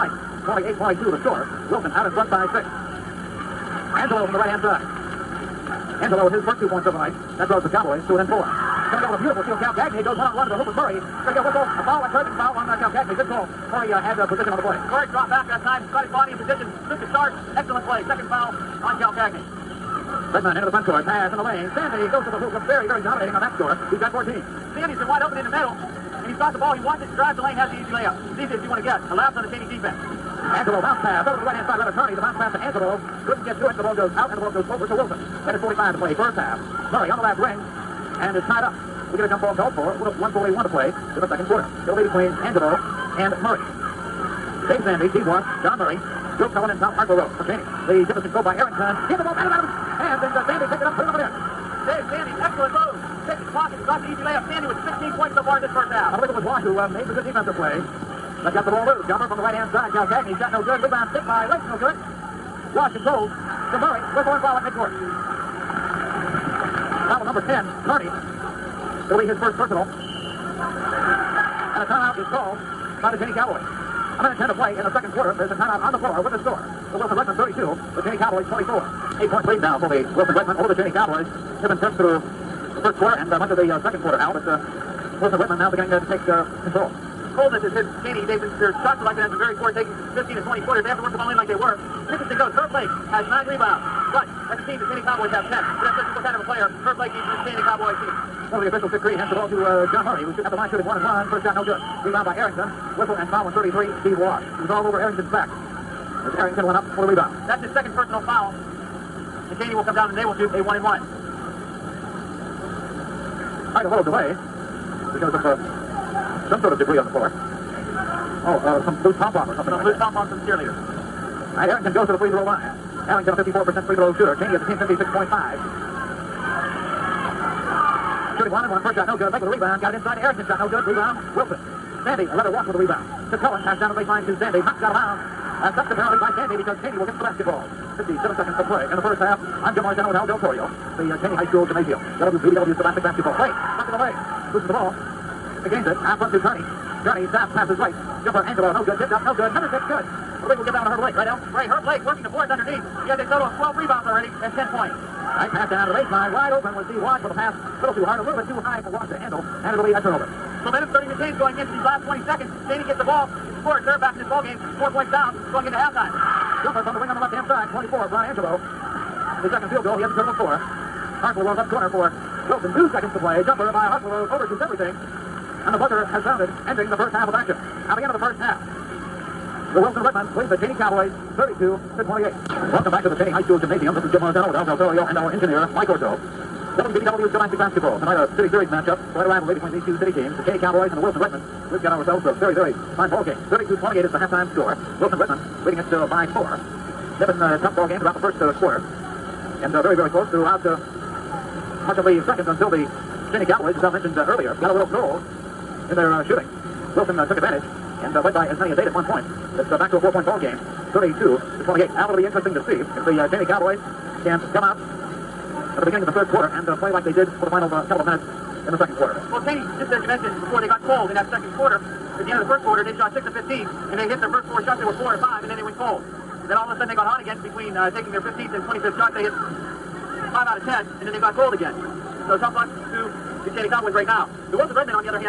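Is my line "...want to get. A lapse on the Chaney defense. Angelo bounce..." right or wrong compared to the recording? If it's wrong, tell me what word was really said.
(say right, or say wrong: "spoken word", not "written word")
right.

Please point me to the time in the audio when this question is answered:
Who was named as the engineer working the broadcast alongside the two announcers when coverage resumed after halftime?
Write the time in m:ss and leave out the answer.
3:05.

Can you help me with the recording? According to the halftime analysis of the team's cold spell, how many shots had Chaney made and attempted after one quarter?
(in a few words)
6 of 15.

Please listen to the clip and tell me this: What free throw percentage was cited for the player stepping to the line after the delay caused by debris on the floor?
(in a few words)
54%.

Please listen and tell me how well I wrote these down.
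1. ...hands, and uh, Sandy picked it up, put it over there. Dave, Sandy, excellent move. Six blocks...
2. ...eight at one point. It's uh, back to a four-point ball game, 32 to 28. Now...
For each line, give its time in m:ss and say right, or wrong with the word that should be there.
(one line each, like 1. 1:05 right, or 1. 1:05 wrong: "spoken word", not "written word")
1. 0:49 right
2. 3:28 right.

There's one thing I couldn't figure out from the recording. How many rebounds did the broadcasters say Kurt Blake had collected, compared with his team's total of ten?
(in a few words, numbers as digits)
9.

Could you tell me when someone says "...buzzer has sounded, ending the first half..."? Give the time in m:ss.
2:55.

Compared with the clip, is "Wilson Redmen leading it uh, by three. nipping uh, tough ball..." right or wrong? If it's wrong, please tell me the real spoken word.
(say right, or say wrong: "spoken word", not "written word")
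wrong: "four", not "three".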